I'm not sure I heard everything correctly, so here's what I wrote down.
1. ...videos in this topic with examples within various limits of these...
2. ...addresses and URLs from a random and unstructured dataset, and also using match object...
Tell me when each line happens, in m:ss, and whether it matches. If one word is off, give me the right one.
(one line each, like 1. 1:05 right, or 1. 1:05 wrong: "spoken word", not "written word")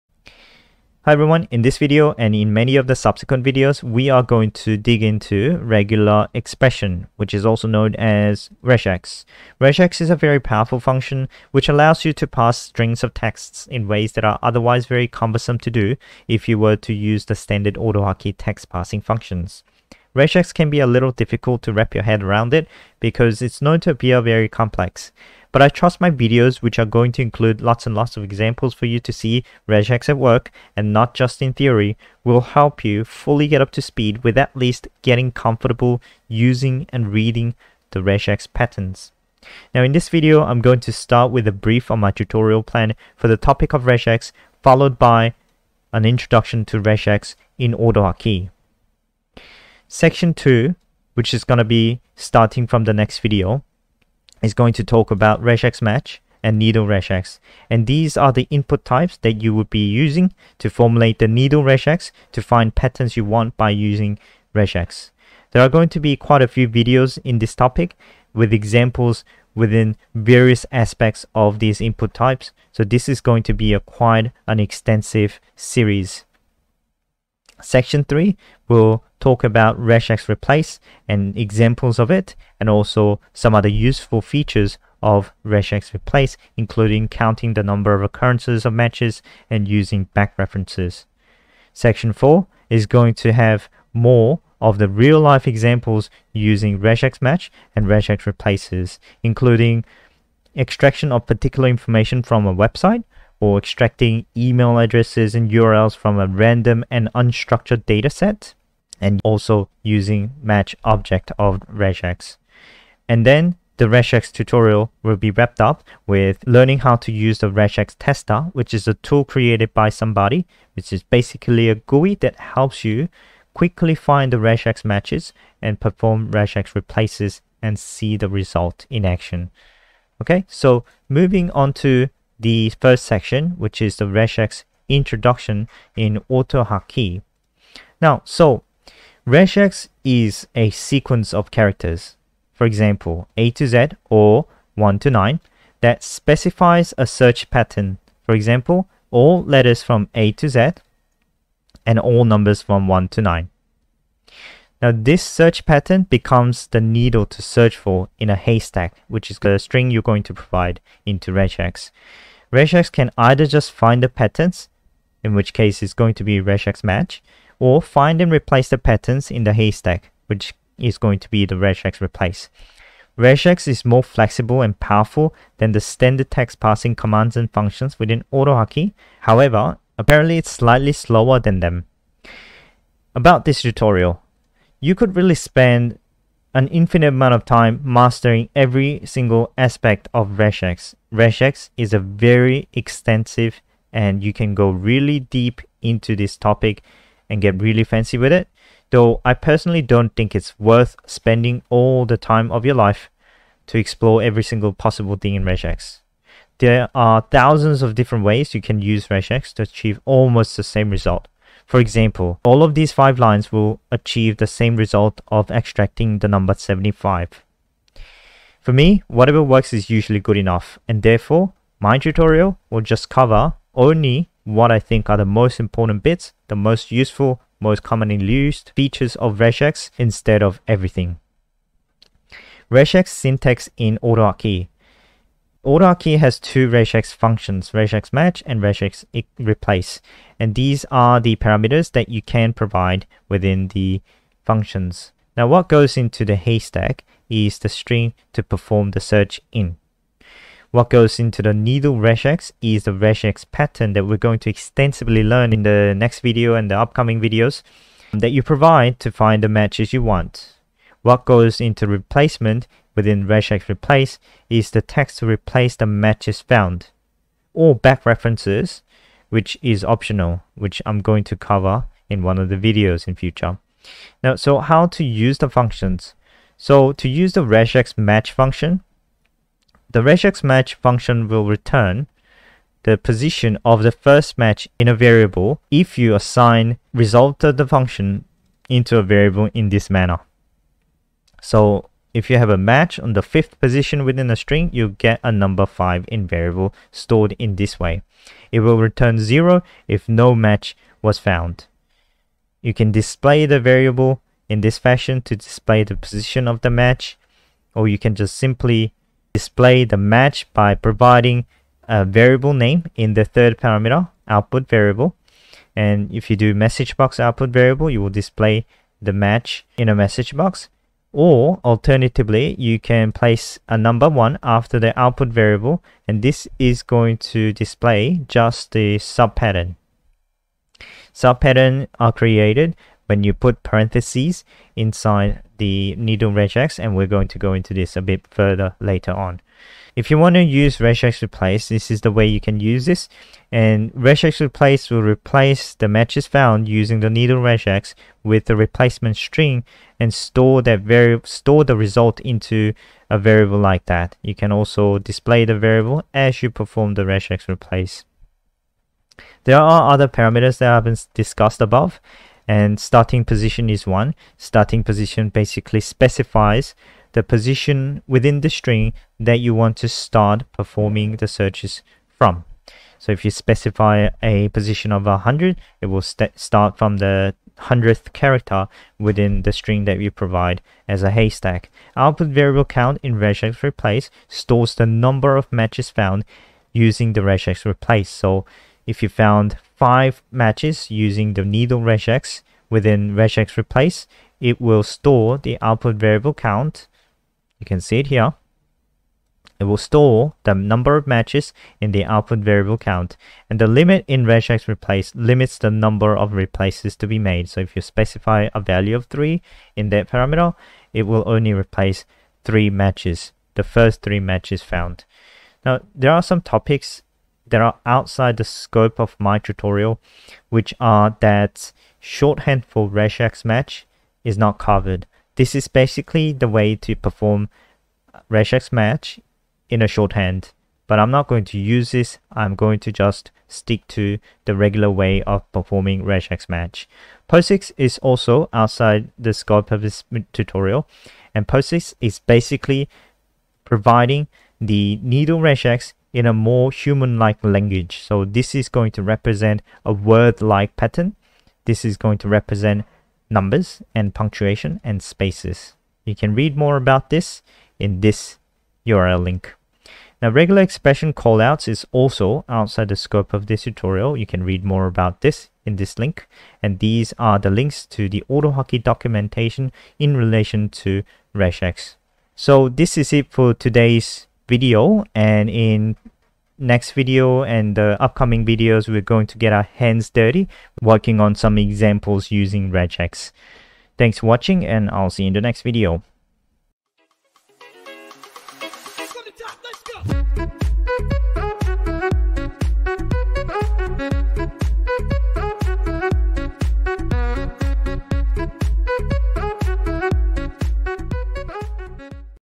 1. 1:06 wrong: "aspects", not "limits"
2. 1:44 right.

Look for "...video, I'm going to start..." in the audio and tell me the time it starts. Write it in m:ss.
0:40.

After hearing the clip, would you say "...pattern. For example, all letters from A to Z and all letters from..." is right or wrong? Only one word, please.
wrong.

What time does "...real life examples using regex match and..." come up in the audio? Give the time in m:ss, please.
1:34.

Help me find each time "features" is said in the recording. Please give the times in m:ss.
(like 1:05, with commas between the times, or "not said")
1:24, 3:48.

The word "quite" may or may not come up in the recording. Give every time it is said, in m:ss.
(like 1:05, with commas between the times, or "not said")
1:06, 1:13.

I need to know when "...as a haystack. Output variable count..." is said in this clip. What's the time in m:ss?
6:20.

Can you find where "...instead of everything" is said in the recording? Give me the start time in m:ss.
3:49.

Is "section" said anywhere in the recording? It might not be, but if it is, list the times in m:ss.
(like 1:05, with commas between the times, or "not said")
0:49, 1:17, 1:31, 2:13.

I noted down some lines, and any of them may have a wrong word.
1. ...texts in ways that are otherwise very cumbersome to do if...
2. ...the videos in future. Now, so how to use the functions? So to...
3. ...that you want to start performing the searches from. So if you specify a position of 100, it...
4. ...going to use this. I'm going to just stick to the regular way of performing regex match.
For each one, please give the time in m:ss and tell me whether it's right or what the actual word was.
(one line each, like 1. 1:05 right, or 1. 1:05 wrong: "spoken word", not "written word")
1. 0:13 right
2. 4:32 right
3. 6:09 right
4. 7:11 right.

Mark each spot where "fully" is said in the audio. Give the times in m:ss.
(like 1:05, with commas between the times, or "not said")
0:33.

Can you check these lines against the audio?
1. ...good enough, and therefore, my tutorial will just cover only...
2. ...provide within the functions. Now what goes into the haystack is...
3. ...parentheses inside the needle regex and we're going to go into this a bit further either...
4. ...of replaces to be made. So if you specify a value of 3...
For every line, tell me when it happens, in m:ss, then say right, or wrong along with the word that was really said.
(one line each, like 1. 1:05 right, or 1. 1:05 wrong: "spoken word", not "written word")
1. 3:40 right
2. 4:02 right
3. 5:33 wrong: "later", not "either"
4. 6:46 right.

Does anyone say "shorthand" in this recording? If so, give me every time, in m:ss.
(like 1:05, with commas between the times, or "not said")
7:01, 7:09.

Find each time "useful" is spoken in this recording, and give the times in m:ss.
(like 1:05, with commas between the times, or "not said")
1:23, 3:46.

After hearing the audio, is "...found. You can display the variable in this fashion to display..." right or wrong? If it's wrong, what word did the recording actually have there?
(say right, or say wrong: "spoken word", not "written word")
right.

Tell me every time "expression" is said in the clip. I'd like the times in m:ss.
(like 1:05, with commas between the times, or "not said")
0:06, 7:40.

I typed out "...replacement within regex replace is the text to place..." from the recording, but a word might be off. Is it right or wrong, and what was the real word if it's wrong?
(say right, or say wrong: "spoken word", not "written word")
wrong: "replace", not "place".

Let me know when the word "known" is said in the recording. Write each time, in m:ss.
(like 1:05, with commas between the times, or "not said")
0:07, 0:23.